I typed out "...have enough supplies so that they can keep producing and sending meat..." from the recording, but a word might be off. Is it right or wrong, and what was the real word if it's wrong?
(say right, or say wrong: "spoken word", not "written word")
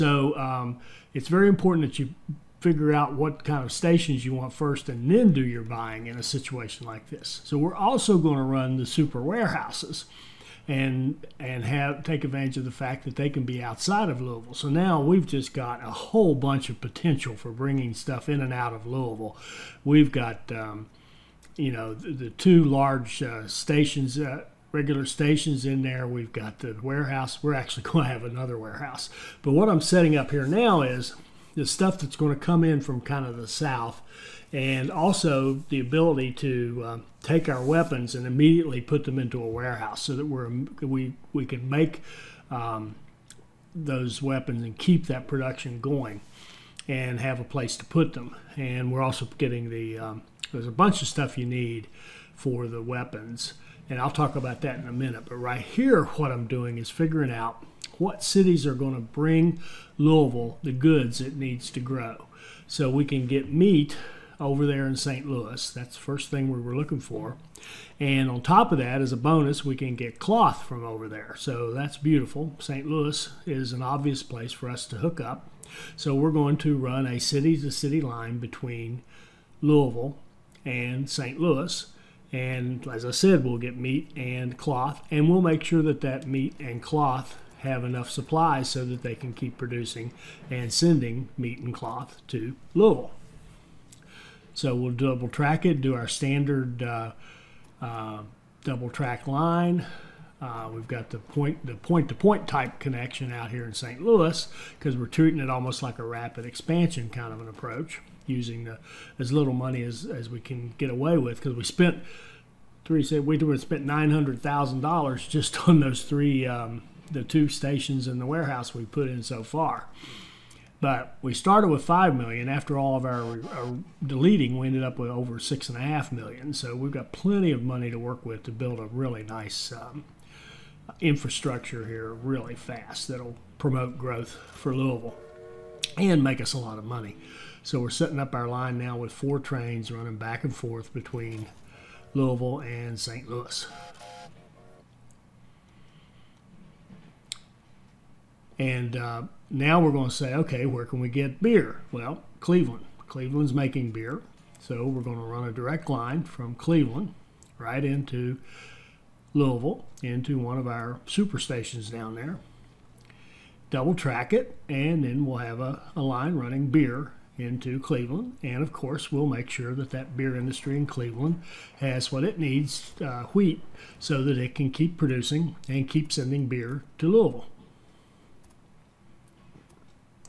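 right.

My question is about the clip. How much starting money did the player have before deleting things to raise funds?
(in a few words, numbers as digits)
5 million.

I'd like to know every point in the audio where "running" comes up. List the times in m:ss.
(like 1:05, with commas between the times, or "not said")
2:19, 2:46.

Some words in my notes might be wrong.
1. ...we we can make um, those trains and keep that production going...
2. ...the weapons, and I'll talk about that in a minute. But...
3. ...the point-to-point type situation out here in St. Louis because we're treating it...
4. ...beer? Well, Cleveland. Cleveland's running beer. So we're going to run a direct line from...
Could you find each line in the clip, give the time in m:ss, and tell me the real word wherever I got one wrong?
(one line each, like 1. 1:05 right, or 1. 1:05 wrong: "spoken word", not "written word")
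1. 0:40 wrong: "weapons", not "trains"
2. 0:52 right
3. 1:41 wrong: "connection", not "situation"
4. 2:31 wrong: "making", not "running".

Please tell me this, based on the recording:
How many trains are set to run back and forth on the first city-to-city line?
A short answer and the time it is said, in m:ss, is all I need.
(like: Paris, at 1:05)
4, at 2:19.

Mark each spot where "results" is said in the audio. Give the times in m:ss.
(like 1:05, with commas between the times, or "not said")
not said.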